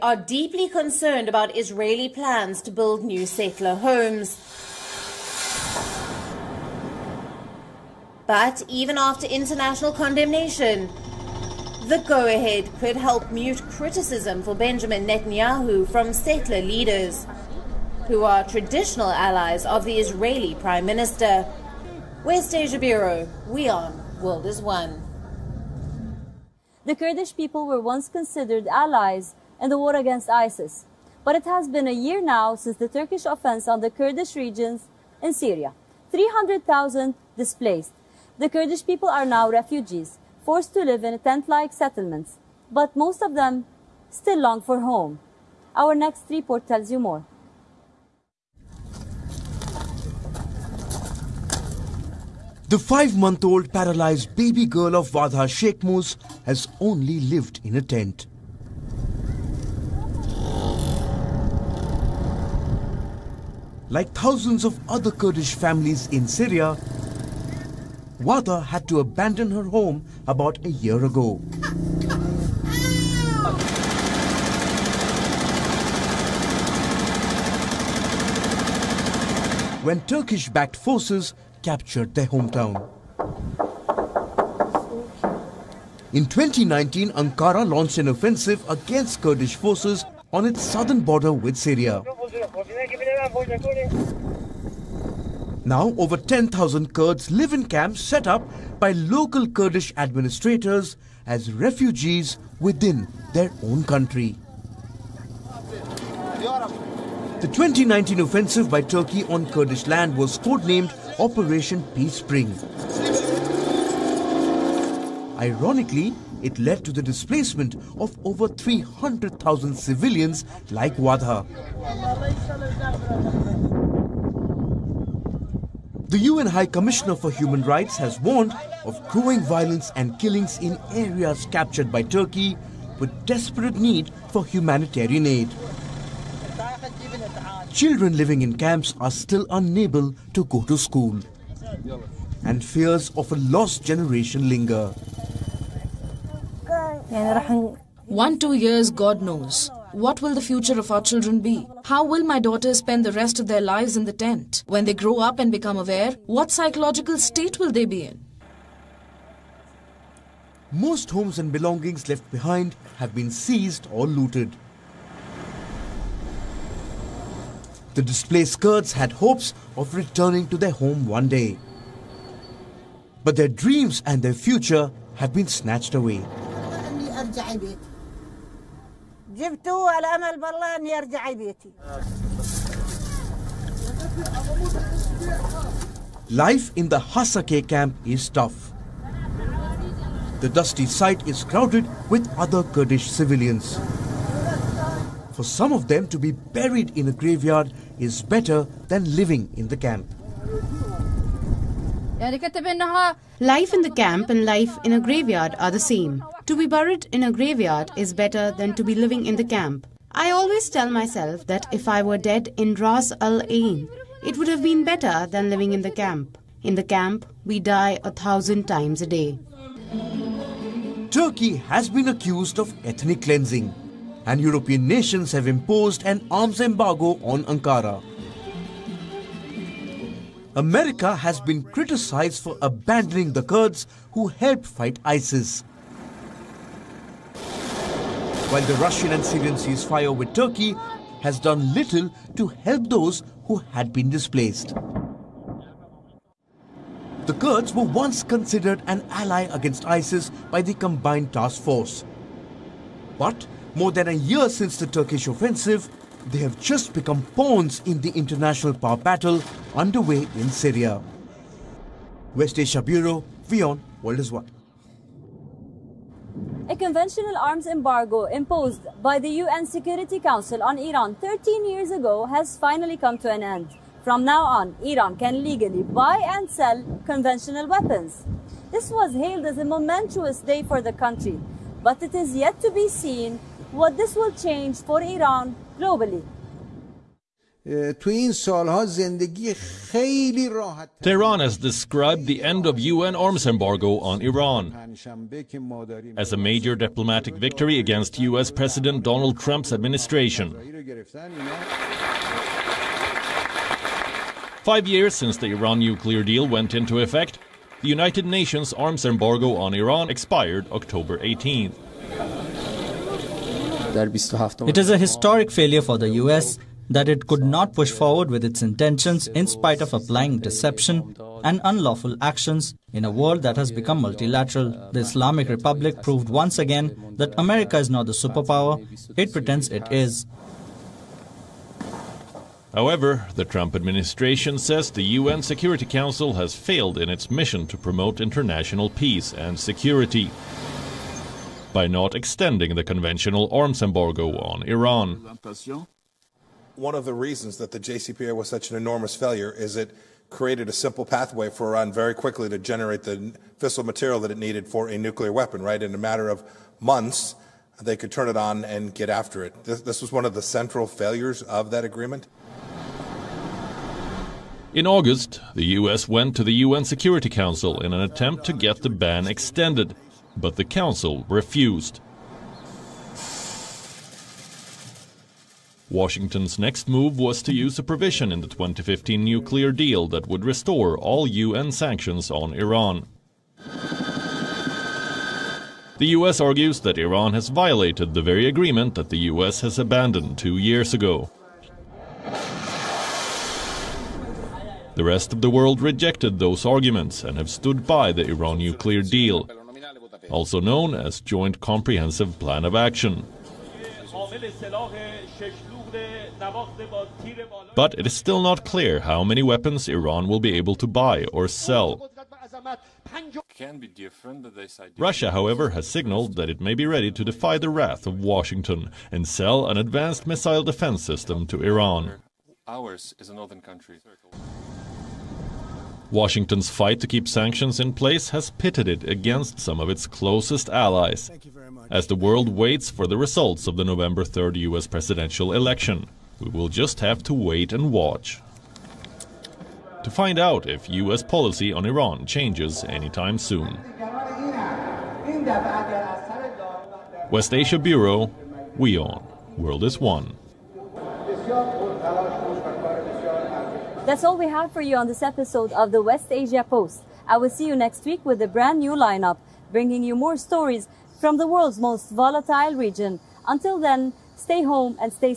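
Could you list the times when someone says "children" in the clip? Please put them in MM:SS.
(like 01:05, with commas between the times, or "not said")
02:17, 02:31.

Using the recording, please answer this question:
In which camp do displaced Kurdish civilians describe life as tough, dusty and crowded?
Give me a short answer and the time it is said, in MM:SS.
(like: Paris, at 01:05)
Hasake, at 03:07.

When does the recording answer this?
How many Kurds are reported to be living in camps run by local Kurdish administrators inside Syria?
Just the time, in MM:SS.
01:35.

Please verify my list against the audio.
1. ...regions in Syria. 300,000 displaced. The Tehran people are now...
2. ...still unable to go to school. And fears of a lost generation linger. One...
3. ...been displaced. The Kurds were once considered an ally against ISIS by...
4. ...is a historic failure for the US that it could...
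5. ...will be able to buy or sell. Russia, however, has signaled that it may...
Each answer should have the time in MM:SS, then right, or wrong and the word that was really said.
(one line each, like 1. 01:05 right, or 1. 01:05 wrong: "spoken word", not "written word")
1. 00:34 wrong: "Kurdish", not "Tehran"
2. 02:19 right
3. 04:03 right
4. 05:14 right
5. 06:50 right.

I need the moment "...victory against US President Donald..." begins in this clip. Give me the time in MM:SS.
04:57.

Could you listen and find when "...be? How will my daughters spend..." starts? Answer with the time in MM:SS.
02:31.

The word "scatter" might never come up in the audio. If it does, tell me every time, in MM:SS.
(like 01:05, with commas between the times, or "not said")
not said.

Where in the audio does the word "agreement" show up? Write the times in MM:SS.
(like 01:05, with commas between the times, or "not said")
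06:01, 06:28.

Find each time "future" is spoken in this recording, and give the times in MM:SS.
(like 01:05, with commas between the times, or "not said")
02:30, 02:54.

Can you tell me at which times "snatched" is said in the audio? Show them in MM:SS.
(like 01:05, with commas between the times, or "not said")
02:55.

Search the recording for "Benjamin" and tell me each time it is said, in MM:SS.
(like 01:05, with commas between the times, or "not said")
00:14.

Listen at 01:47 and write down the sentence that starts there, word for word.
The 2019 offensive by Turkey on Kurdish land was codenamed Operation Peace Spring.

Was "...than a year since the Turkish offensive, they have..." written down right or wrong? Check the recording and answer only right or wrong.
right.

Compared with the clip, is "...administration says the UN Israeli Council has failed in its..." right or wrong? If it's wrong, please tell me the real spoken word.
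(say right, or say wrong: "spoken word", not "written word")
wrong: "Security", not "Israeli".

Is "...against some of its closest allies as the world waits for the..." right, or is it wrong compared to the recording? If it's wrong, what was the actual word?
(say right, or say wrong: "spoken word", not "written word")
right.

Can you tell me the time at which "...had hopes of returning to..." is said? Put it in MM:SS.
02:48.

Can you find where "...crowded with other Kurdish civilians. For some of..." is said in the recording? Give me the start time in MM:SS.
03:11.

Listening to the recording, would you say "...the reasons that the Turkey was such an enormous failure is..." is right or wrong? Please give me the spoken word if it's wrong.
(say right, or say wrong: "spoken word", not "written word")
wrong: "JCPOA", not "Turkey".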